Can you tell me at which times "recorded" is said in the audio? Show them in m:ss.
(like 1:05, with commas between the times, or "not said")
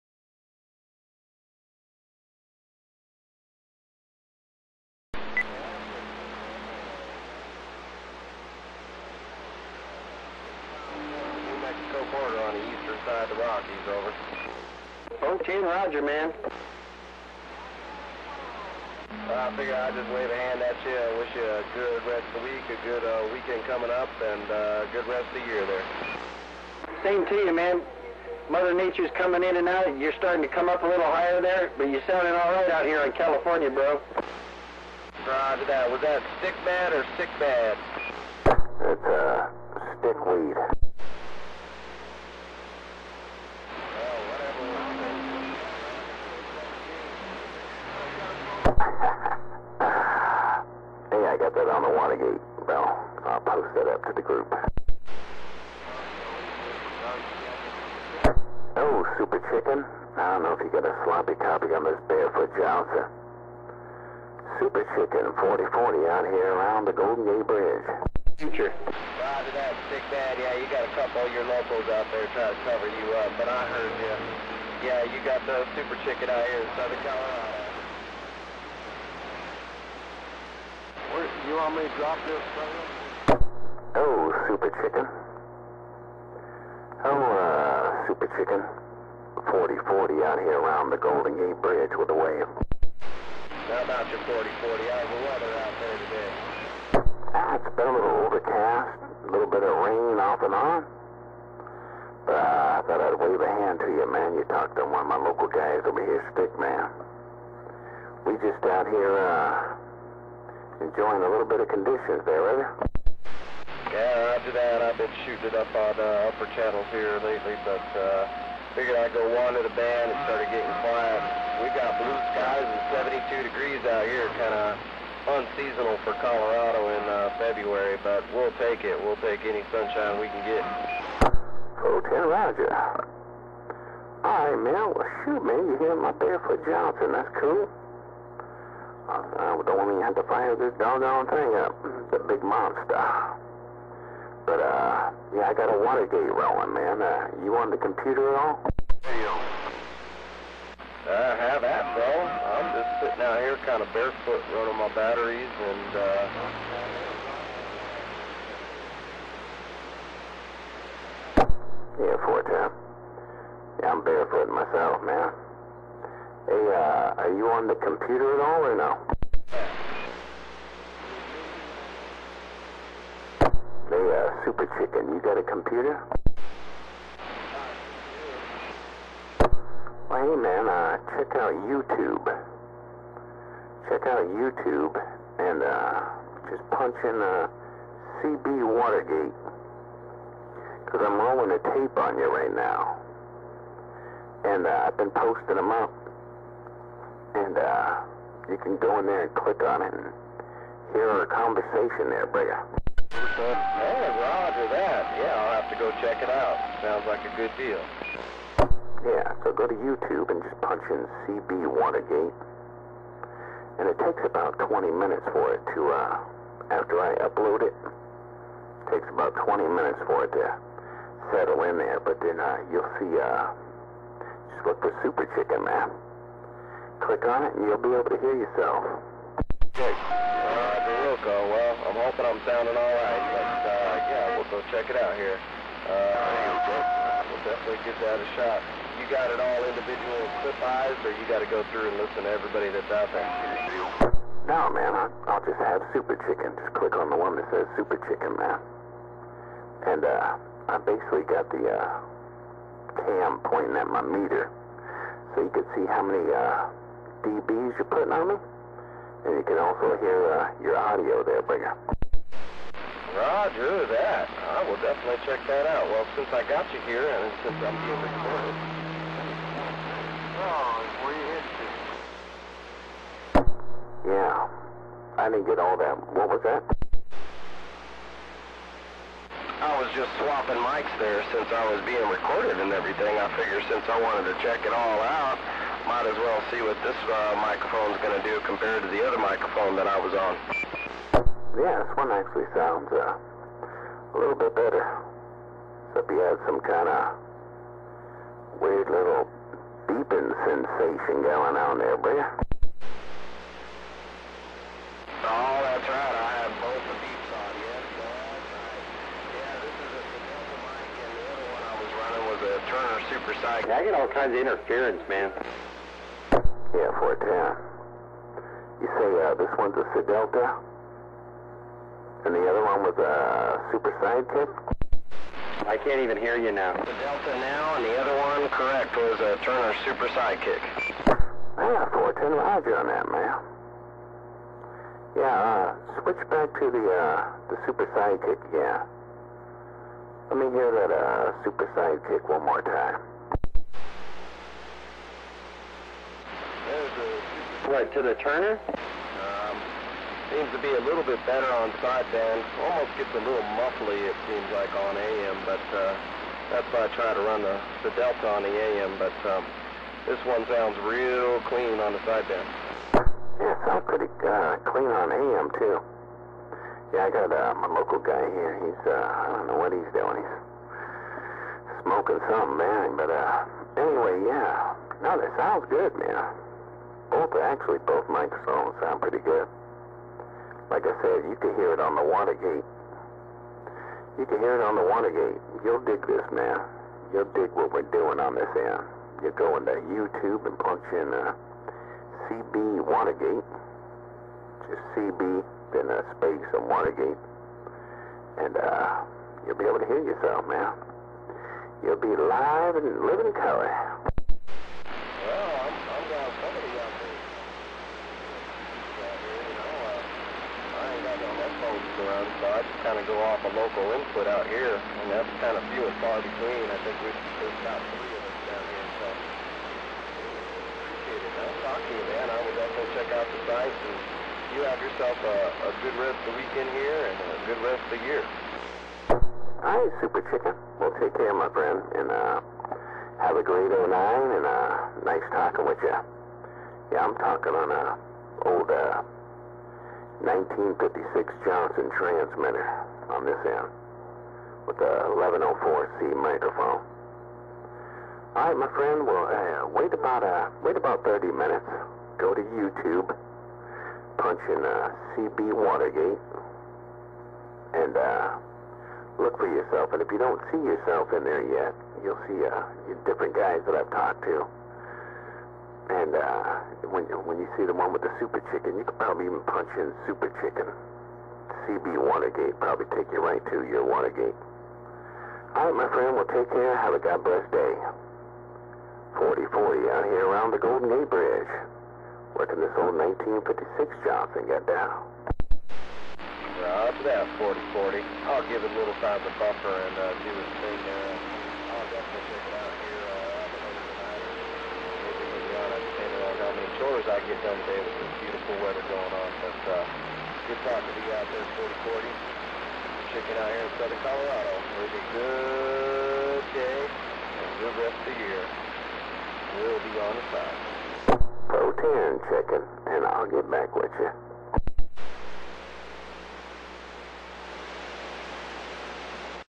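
4:28, 4:42.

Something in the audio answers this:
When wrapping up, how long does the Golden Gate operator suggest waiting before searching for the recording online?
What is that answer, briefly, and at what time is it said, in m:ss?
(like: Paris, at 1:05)
30 minutes, at 7:31.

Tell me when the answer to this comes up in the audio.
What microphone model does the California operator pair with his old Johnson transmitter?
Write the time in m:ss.
7:25.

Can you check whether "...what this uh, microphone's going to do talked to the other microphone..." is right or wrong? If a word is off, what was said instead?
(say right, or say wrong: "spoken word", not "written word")
wrong: "compared", not "talked".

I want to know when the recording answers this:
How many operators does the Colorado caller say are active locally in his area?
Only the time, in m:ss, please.
6:57.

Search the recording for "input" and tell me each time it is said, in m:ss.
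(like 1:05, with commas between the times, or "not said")
6:53.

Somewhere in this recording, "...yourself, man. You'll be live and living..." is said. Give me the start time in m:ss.
6:40.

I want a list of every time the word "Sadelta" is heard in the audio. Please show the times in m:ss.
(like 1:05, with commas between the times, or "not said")
5:19, 5:26.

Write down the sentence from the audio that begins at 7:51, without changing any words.
CB Watergate probably take you right to your Watergate.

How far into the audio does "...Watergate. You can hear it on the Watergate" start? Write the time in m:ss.
6:22.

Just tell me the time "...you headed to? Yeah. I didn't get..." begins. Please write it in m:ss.
4:31.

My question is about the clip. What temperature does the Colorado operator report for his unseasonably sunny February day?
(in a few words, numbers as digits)
72 degrees.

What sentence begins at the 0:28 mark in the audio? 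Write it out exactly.
Mother Nature's coming in and out.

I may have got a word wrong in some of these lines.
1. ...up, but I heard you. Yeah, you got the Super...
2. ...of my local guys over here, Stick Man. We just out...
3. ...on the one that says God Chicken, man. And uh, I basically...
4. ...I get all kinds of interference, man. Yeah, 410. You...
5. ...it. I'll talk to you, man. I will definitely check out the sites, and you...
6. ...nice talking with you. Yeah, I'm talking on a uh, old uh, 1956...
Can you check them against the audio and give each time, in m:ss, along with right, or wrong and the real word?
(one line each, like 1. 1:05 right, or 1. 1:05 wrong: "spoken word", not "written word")
1. 1:13 right
2. 1:45 right
3. 4:06 wrong: "Super", not "God"
4. 5:13 right
5. 7:01 right
6. 7:15 right.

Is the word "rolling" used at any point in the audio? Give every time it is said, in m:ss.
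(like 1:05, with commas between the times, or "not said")
2:26, 3:11.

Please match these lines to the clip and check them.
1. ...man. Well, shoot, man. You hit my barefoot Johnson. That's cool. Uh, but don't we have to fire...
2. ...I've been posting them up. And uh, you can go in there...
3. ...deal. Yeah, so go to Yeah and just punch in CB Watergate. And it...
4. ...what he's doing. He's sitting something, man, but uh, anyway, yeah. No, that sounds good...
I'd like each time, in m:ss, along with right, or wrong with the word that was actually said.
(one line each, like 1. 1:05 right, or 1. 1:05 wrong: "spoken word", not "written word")
1. 2:14 right
2. 3:14 right
3. 3:27 wrong: "YouTube", not "Yeah"
4. 6:09 wrong: "smoking", not "sitting".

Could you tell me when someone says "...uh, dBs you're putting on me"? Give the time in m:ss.
4:16.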